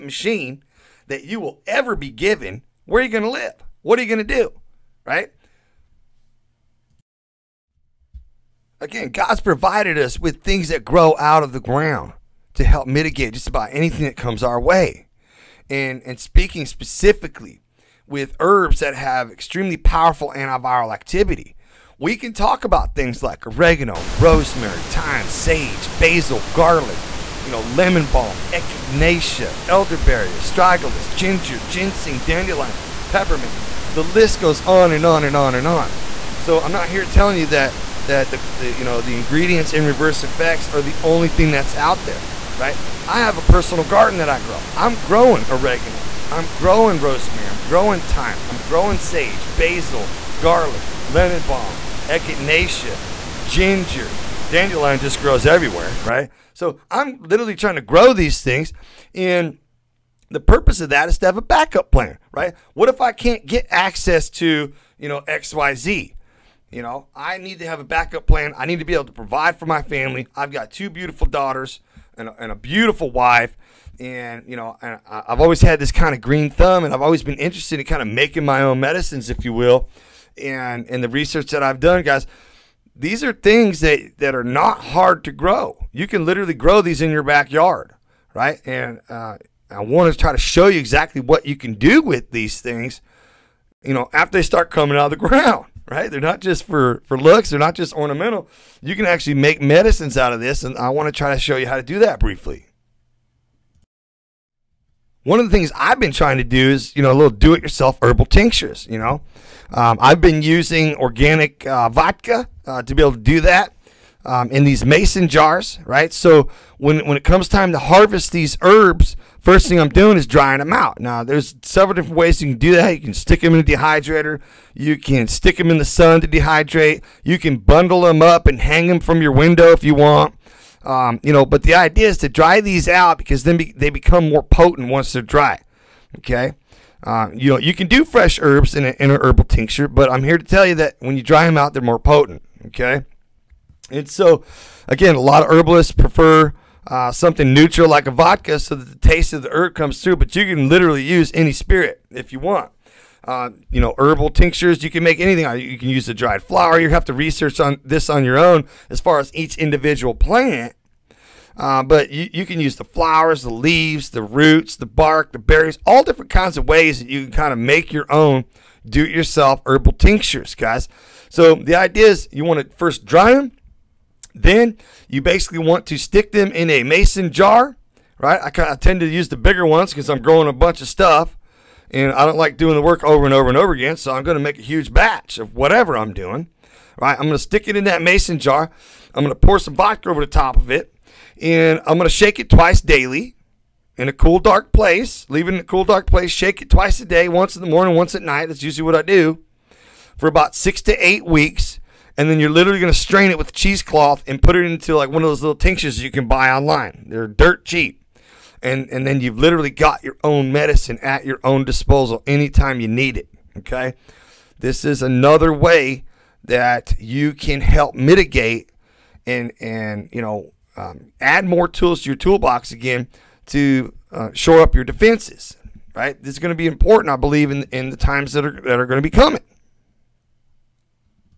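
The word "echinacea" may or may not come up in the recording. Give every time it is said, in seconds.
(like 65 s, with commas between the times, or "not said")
28 s, 52 s.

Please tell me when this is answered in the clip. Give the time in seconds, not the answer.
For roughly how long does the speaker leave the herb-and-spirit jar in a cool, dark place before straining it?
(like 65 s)
200 s.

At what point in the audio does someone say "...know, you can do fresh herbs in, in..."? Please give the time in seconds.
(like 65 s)
137 s.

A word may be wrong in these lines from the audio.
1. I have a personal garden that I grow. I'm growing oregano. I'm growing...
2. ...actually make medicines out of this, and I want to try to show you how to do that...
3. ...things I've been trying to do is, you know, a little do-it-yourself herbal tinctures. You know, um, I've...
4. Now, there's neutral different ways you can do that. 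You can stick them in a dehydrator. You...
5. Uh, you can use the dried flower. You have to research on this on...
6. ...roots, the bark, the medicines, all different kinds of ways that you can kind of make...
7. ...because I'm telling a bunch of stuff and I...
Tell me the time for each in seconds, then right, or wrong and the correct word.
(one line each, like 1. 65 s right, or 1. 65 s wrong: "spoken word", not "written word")
1. 43 s right
2. 99 s right
3. 105 s right
4. 120 s wrong: "several", not "neutral"
5. 155 s right
6. 164 s wrong: "berries", not "medicines"
7. 179 s wrong: "growing", not "telling".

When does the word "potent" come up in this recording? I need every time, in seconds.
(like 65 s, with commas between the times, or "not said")
134 s, 141 s.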